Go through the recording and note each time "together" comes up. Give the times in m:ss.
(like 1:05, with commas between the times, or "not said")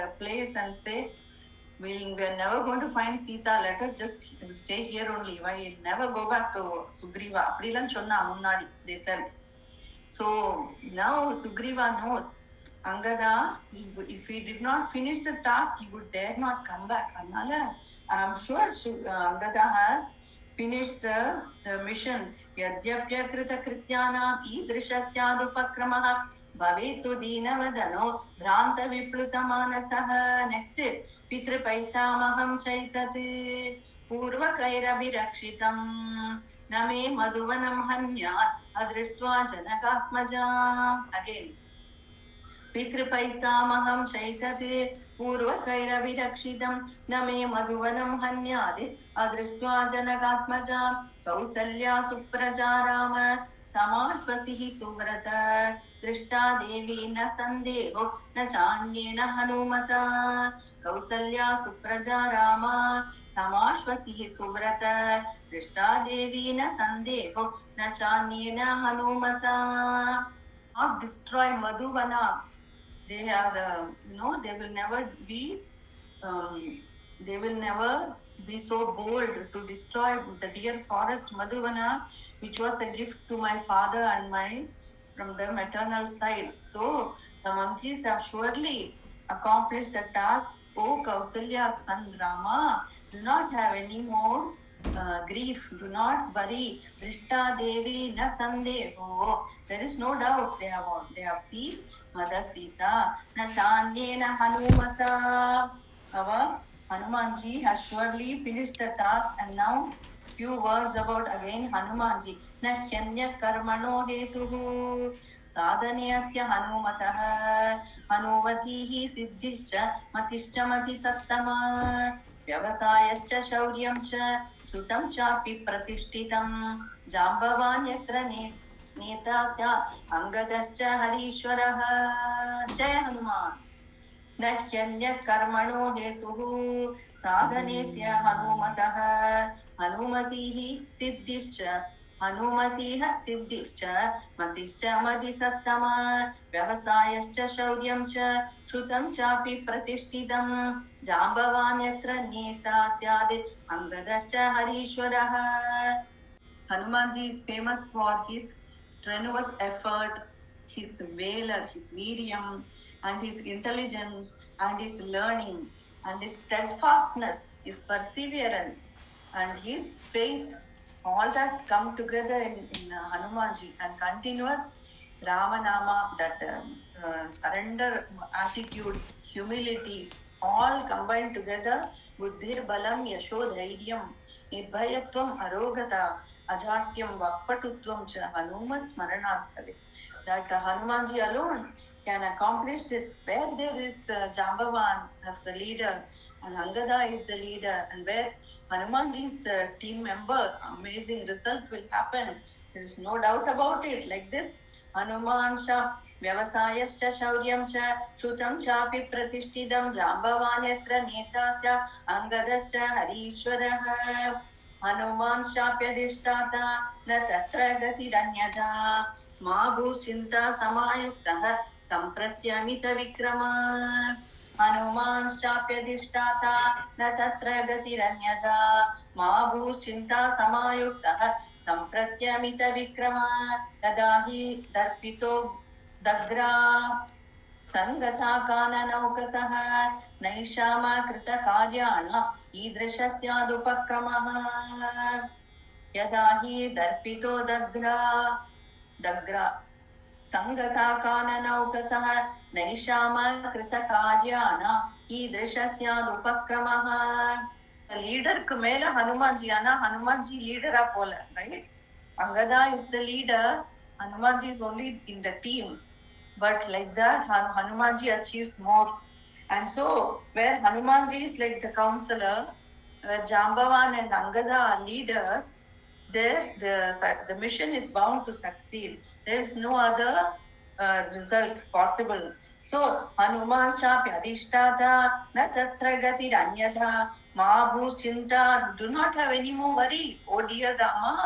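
2:51, 3:01.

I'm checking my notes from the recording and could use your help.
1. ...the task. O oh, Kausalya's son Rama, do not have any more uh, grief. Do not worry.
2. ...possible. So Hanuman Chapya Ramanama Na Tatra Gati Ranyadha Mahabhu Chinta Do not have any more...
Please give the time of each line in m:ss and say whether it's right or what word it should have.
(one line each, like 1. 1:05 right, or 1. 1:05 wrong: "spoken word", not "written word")
1. 1:29 right
2. 4:41 wrong: "Adhishtadha", not "Ramanama".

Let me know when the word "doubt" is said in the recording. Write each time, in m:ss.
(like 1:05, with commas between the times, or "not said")
1:40, 3:23.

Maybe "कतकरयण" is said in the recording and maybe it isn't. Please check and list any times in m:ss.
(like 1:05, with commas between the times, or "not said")
4:01, 4:13.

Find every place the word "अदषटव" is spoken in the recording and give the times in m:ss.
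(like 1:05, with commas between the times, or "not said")
0:38, 0:49.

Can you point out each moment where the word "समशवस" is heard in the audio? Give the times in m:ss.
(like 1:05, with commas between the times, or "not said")
0:53, 1:03.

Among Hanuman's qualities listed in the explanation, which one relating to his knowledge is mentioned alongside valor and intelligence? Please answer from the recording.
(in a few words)
learning.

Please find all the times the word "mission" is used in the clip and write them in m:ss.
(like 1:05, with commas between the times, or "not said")
0:21, 4:37.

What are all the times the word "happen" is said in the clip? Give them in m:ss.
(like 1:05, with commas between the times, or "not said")
3:21.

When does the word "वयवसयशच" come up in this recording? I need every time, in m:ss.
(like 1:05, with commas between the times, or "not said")
2:02, 2:26, 3:26.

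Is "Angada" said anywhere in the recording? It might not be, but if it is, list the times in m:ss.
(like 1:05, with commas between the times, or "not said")
0:12, 0:18, 3:16.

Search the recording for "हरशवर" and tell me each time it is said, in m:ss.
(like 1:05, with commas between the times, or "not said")
2:11, 2:34, 3:32.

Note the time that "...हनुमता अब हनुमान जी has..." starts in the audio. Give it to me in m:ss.
1:44.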